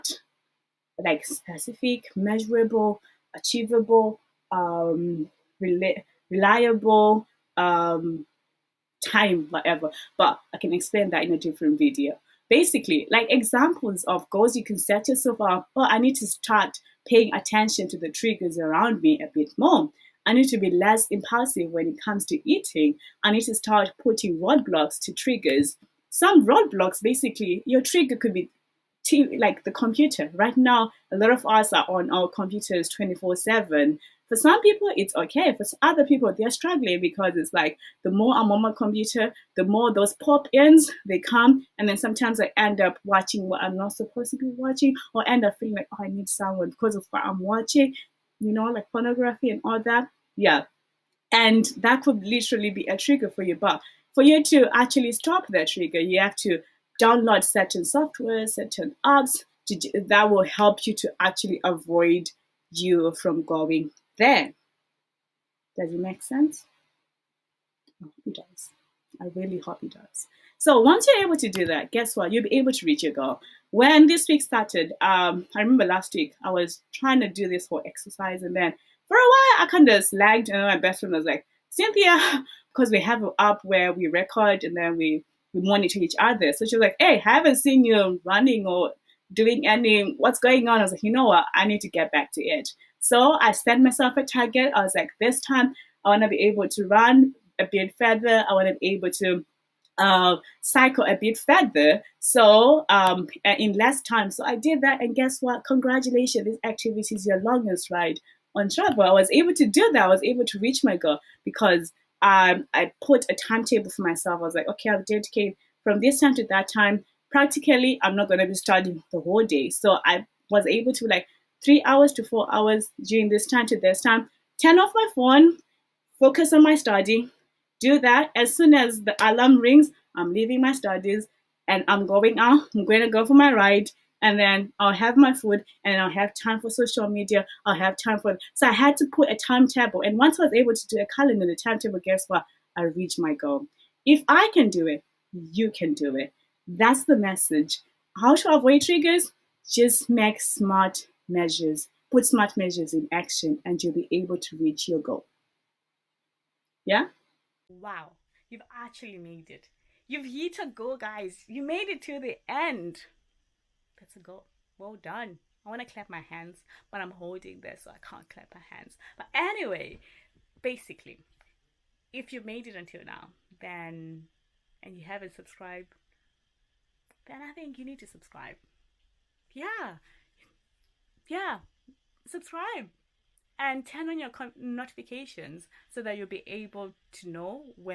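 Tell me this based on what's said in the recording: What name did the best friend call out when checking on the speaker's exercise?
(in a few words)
Cynthia.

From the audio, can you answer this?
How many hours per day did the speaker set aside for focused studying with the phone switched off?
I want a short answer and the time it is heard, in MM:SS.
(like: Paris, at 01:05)
3 to 4 hours, at 02:01.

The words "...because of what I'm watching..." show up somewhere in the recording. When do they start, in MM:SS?
00:46.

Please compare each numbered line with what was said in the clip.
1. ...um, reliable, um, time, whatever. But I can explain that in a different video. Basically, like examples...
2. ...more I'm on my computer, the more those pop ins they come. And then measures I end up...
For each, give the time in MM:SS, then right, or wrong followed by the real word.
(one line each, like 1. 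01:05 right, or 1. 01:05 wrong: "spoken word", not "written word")
1. 00:04 right
2. 00:38 wrong: "sometimes", not "measures".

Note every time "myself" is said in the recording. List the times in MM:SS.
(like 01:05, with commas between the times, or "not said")
01:33, 01:54.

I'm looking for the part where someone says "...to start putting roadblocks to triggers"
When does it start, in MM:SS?
00:23.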